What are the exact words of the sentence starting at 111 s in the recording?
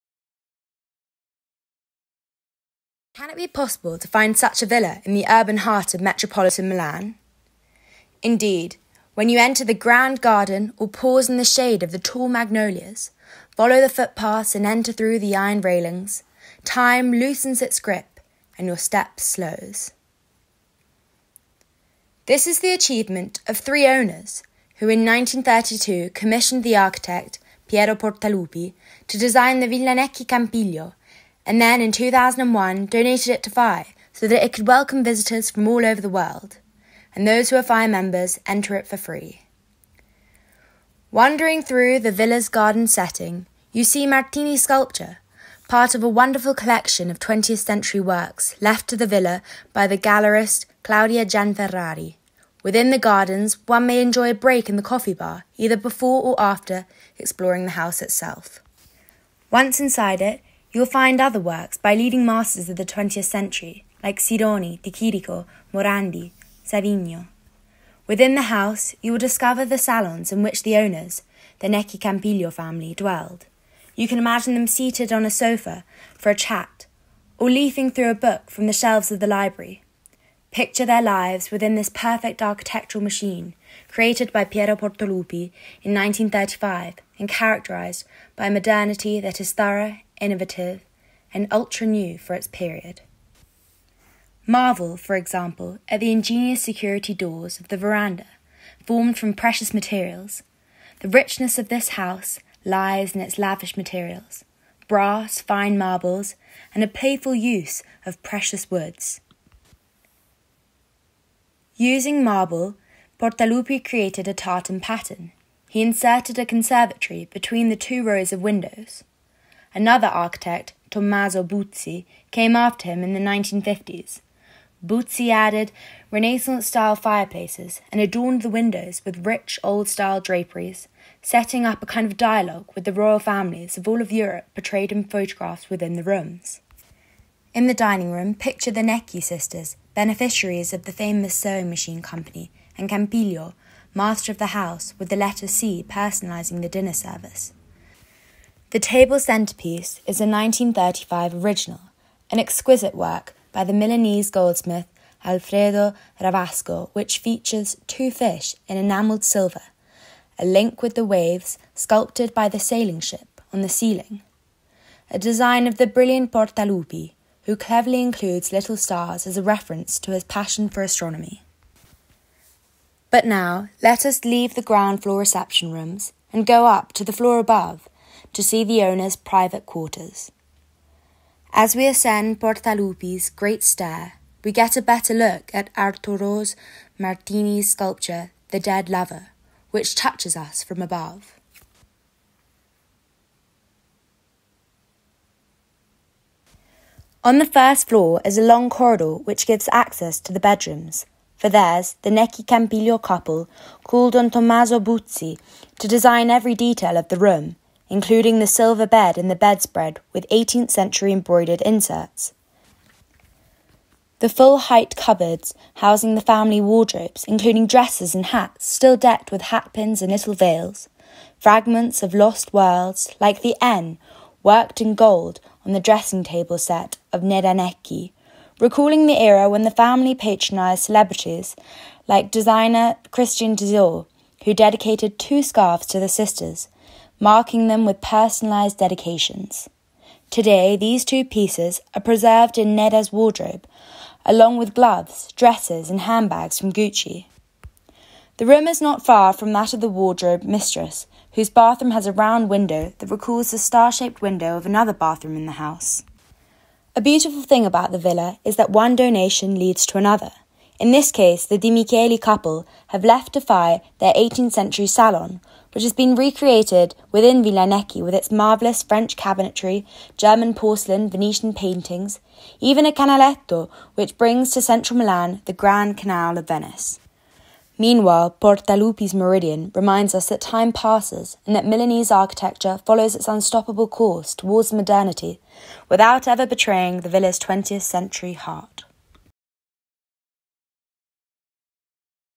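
Using marble, Portalupi created a tartan pattern.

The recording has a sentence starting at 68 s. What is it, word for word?
Within the house, you will discover the salons in which the owners, the Necchi Campiglio family, dwelled.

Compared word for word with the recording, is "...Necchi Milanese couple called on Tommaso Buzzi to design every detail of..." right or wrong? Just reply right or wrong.
wrong.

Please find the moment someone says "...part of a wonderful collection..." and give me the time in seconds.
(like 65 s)
45 s.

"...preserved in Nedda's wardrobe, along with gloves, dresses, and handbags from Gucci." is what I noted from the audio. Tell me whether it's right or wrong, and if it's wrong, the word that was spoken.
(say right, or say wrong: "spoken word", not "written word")
right.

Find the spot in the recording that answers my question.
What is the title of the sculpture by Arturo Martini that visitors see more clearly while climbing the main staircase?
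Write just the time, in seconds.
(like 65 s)
188 s.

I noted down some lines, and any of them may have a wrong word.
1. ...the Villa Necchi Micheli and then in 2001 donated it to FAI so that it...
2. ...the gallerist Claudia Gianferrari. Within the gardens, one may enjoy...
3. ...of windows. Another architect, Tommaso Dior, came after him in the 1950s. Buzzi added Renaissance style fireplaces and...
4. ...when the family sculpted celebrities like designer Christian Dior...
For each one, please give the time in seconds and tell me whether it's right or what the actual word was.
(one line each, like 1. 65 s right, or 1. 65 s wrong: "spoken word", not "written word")
1. 29 s wrong: "Campiglio", not "Micheli"
2. 49 s right
3. 118 s wrong: "Buzzi", not "Dior"
4. 229 s wrong: "patronised", not "sculpted".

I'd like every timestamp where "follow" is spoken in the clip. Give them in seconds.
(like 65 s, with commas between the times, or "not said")
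13 s, 282 s.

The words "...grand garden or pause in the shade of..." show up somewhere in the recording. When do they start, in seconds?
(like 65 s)
9 s.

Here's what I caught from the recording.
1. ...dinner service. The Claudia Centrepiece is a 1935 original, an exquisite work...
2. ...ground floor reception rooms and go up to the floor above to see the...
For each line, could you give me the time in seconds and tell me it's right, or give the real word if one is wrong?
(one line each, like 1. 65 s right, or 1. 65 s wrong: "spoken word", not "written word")
1. 146 s wrong: "Table", not "Claudia"
2. 174 s right.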